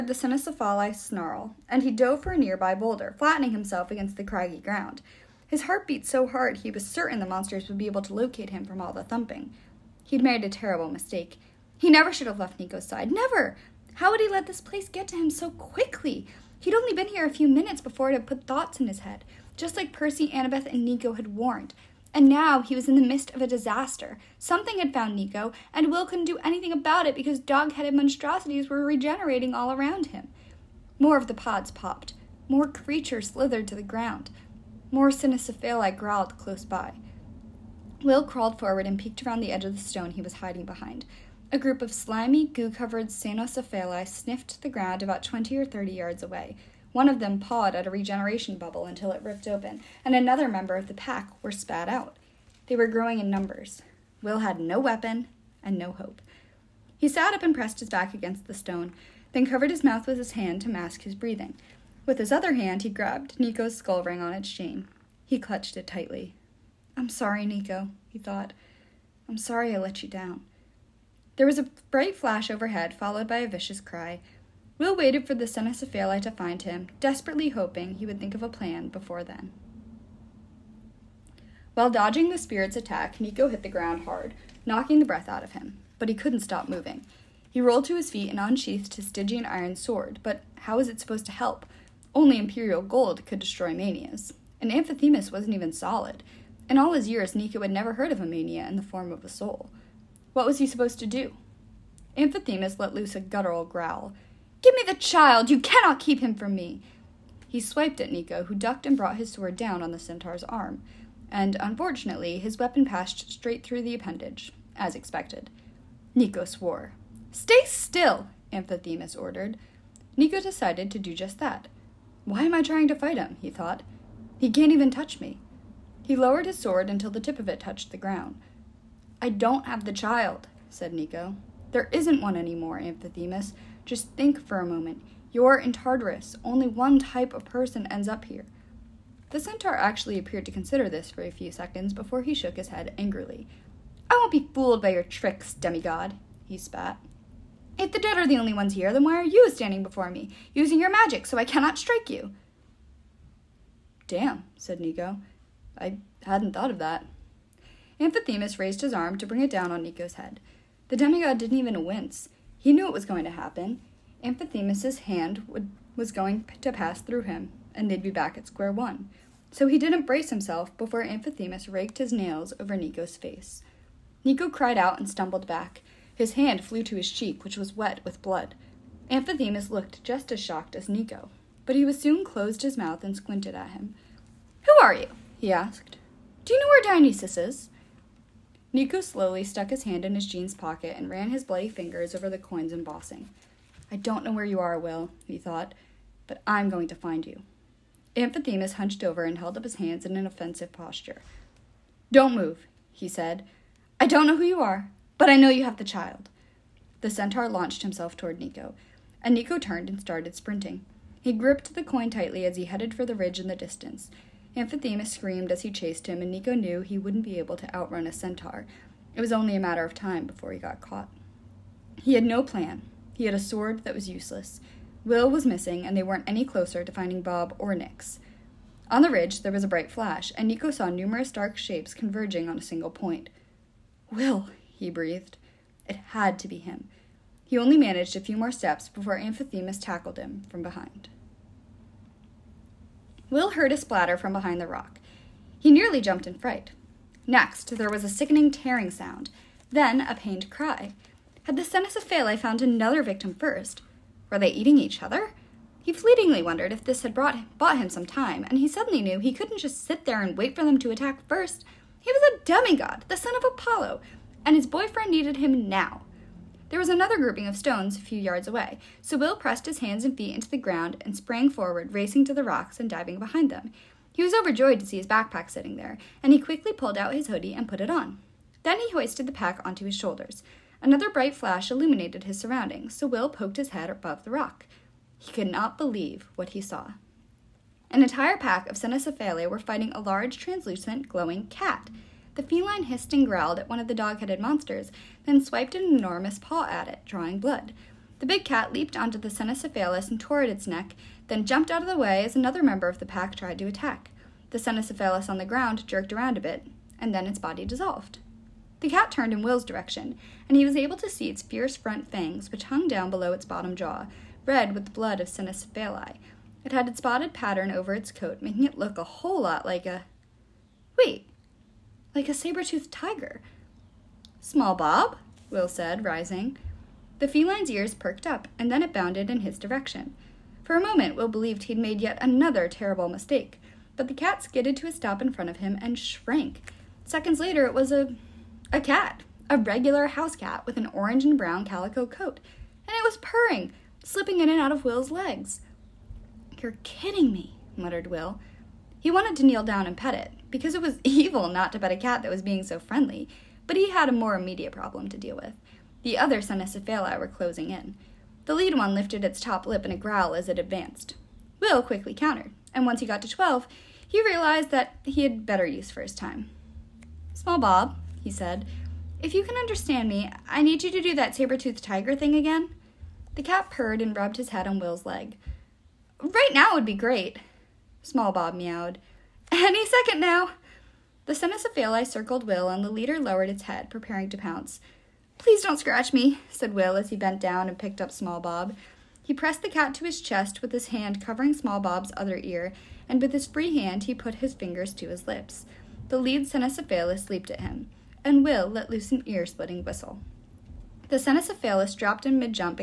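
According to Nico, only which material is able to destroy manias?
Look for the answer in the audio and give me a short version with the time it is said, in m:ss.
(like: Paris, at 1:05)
Imperial gold, at 1:32.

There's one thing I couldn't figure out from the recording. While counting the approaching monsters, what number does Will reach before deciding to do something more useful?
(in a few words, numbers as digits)
12.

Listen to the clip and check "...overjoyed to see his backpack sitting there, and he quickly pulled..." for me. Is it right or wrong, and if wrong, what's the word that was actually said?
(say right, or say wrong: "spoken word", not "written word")
right.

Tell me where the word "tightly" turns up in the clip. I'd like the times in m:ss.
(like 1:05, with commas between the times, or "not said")
1:05, 3:32.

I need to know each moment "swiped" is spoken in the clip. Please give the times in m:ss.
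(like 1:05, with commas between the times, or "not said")
1:47, 4:55.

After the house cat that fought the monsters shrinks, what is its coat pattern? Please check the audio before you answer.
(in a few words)
orange and brown calico.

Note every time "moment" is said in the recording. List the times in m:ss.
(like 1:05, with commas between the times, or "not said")
2:14, 5:30.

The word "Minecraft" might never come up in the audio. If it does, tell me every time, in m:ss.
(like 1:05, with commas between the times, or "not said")
not said.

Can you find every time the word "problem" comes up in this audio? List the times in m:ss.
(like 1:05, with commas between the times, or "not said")
5:54.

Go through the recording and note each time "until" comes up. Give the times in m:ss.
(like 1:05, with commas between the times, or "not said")
0:48, 2:06.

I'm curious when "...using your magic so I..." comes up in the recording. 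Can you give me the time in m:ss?
2:30.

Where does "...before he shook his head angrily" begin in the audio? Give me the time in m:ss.
2:21.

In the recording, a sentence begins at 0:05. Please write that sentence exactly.
His heart beat so hard he was certain the monsters would be able to locate him from all the thumping.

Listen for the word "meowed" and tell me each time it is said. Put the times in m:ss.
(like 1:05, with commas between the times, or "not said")
6:18.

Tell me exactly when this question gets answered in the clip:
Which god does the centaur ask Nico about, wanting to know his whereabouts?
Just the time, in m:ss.
3:06.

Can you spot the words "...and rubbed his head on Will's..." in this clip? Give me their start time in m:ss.
6:14.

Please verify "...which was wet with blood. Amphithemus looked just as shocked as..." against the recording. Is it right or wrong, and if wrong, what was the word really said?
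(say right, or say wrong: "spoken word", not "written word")
right.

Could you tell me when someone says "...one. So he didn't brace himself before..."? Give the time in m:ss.
2:48.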